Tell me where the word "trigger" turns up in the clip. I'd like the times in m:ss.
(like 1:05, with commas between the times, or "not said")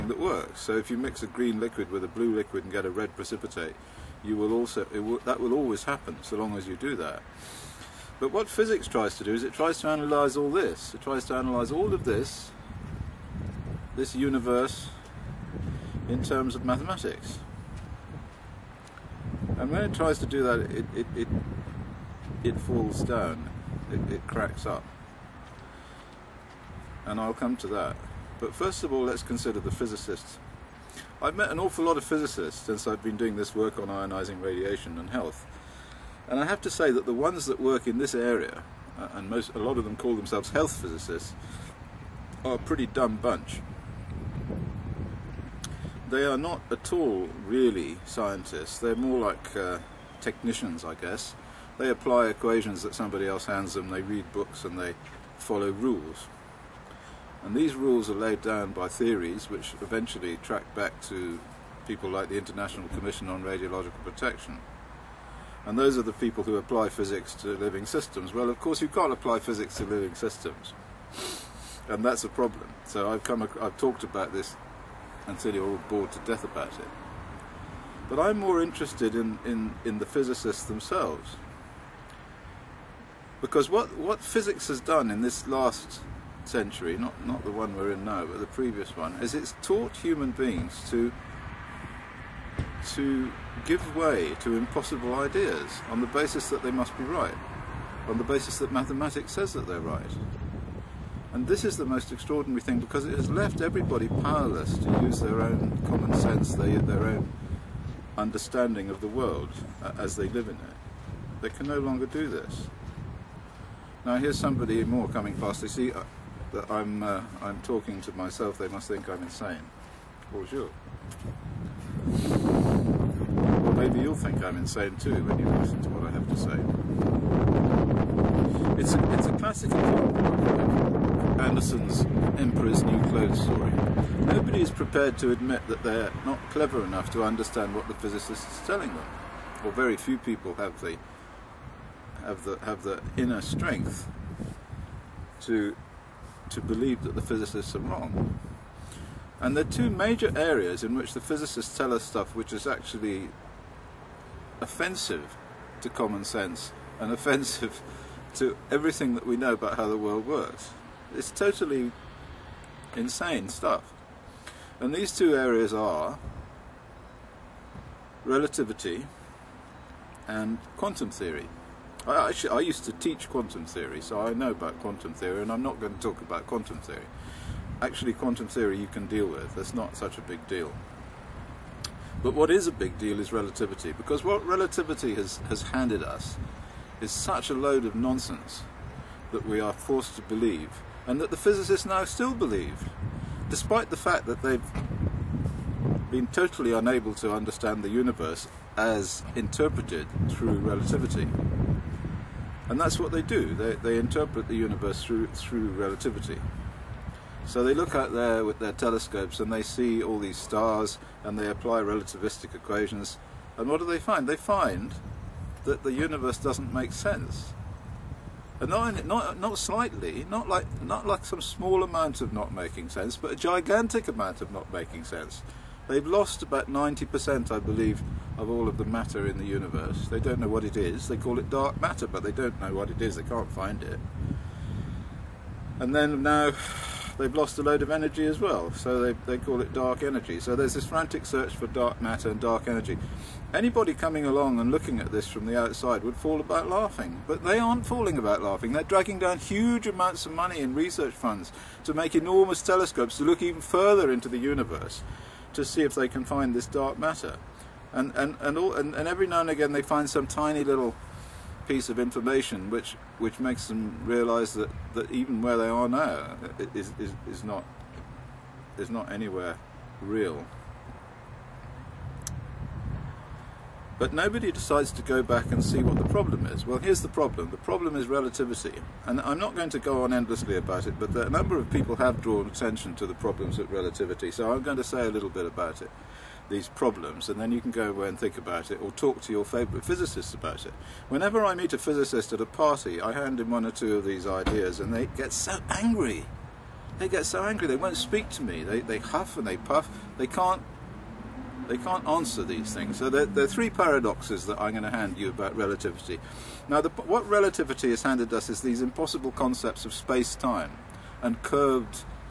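not said.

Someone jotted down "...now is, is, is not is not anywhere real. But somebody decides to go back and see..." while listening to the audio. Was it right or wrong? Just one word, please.
wrong.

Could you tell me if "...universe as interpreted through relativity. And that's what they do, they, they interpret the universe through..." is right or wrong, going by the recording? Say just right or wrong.
right.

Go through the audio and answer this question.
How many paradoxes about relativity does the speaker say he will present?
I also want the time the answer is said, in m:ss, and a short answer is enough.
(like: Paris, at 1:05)
3, at 5:03.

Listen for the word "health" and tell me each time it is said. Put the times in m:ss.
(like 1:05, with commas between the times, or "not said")
0:35, 0:40.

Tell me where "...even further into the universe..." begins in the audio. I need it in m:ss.
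4:13.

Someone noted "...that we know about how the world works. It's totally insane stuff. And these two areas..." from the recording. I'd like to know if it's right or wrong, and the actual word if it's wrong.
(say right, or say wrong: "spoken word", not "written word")
right.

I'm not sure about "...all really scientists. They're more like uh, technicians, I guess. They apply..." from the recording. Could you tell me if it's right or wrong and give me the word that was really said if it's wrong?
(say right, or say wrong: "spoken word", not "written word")
right.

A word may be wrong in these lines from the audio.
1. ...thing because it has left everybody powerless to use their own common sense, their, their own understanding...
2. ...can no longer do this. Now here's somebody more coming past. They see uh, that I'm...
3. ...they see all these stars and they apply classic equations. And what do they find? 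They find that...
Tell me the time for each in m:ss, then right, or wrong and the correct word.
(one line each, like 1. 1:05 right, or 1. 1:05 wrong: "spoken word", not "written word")
1. 1:42 right
2. 1:51 right
3. 3:29 wrong: "relativistic", not "classic".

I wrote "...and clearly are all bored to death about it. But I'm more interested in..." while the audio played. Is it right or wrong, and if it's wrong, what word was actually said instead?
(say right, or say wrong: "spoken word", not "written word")
right.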